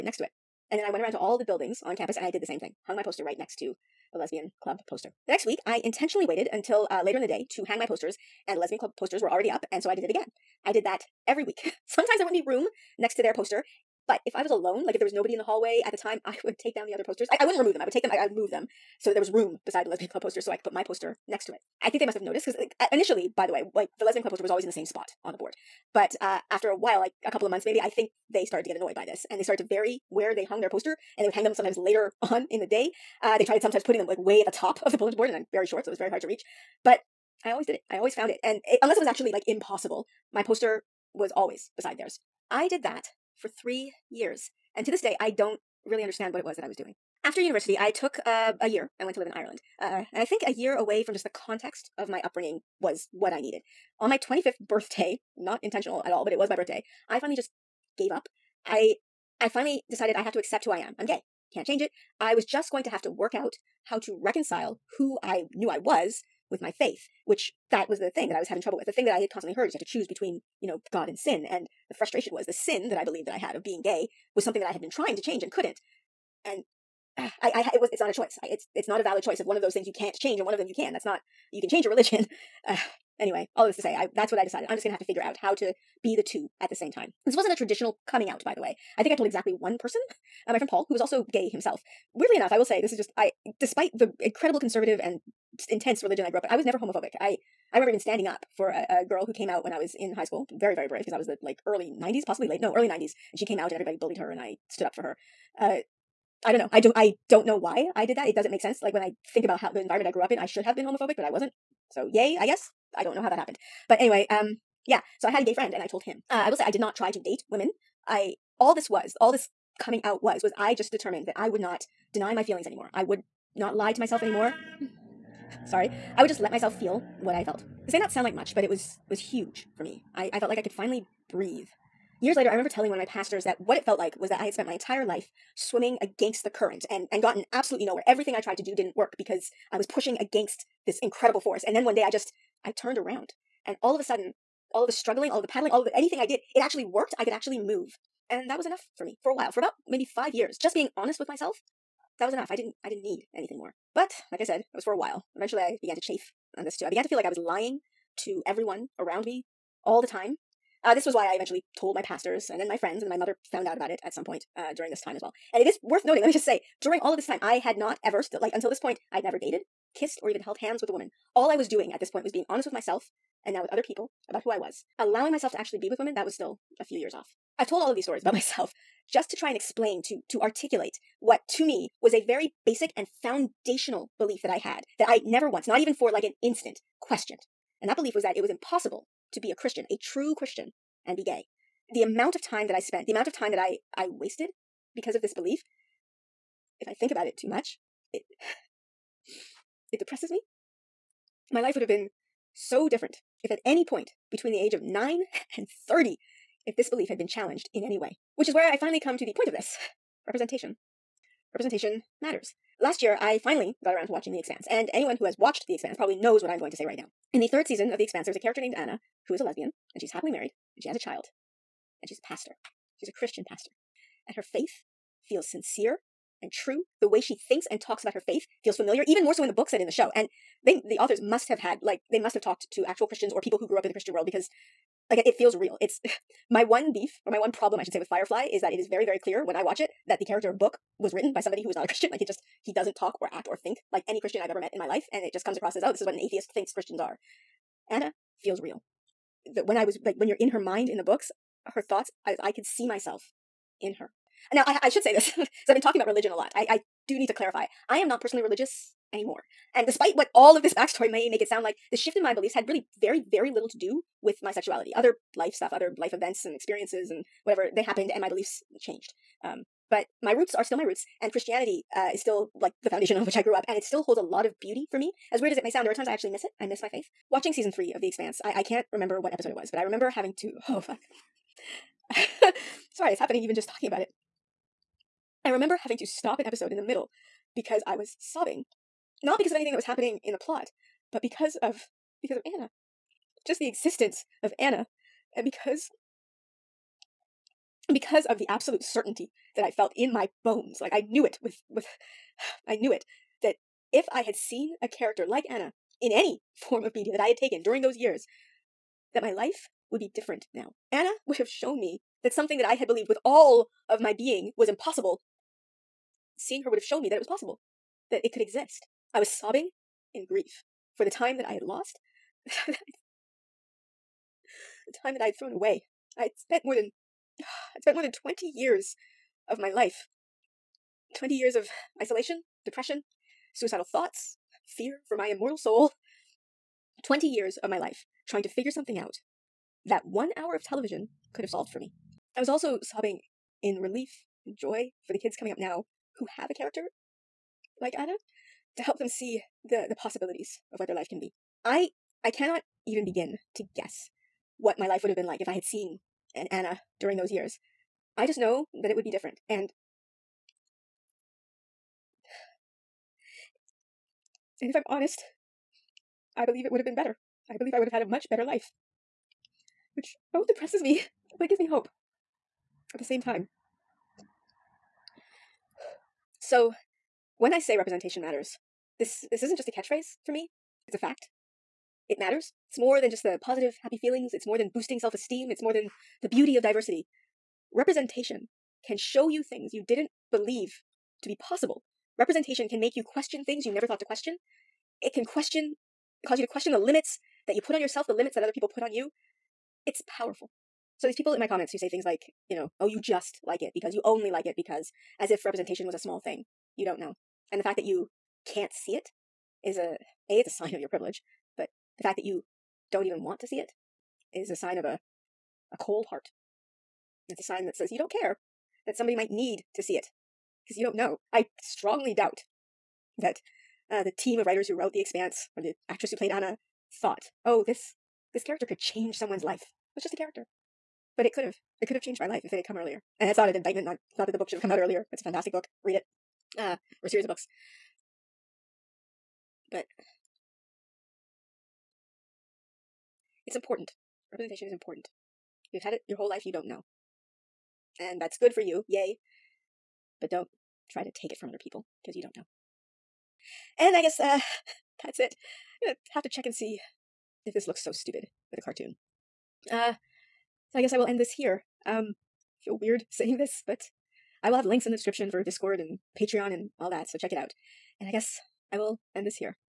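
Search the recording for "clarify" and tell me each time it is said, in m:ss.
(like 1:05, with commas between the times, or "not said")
4:17.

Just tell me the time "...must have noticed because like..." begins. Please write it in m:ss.
0:22.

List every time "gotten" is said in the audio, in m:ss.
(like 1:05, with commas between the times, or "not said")
2:17.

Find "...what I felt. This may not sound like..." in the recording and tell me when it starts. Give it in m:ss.
2:07.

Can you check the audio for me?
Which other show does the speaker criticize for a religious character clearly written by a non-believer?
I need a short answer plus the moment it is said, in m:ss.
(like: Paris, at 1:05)
Firefly, at 3:58.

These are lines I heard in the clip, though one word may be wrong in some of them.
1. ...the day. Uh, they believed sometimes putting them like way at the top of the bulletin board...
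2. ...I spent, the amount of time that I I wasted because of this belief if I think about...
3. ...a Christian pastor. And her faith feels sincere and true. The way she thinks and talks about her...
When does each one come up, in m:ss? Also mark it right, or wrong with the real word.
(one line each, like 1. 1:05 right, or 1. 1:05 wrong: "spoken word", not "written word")
1. 0:32 wrong: "tried", not "believed"
2. 3:12 right
3. 3:43 right.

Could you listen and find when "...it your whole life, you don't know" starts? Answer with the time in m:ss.
7:25.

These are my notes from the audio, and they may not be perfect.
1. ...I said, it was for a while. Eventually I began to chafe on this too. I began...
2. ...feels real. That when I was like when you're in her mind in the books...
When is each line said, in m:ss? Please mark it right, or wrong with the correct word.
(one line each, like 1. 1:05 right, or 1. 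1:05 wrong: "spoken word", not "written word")
1. 2:34 right
2. 4:08 right.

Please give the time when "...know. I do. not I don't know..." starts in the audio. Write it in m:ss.
1:46.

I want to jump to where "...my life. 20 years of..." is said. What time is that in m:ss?
5:29.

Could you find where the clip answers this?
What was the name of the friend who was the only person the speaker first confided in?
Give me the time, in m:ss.
1:30.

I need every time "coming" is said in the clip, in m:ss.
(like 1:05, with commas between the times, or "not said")
1:28, 1:59, 5:45.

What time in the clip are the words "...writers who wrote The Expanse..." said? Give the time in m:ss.
7:04.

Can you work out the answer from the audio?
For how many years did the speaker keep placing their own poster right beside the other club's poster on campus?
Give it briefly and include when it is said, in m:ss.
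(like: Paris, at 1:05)
3, at 0:43.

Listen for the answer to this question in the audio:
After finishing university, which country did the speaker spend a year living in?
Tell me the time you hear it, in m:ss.
0:49.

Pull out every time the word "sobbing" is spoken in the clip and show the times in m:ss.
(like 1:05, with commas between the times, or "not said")
4:48, 5:19, 5:42.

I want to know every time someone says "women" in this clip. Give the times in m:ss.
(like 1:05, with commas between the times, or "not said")
1:57, 2:55.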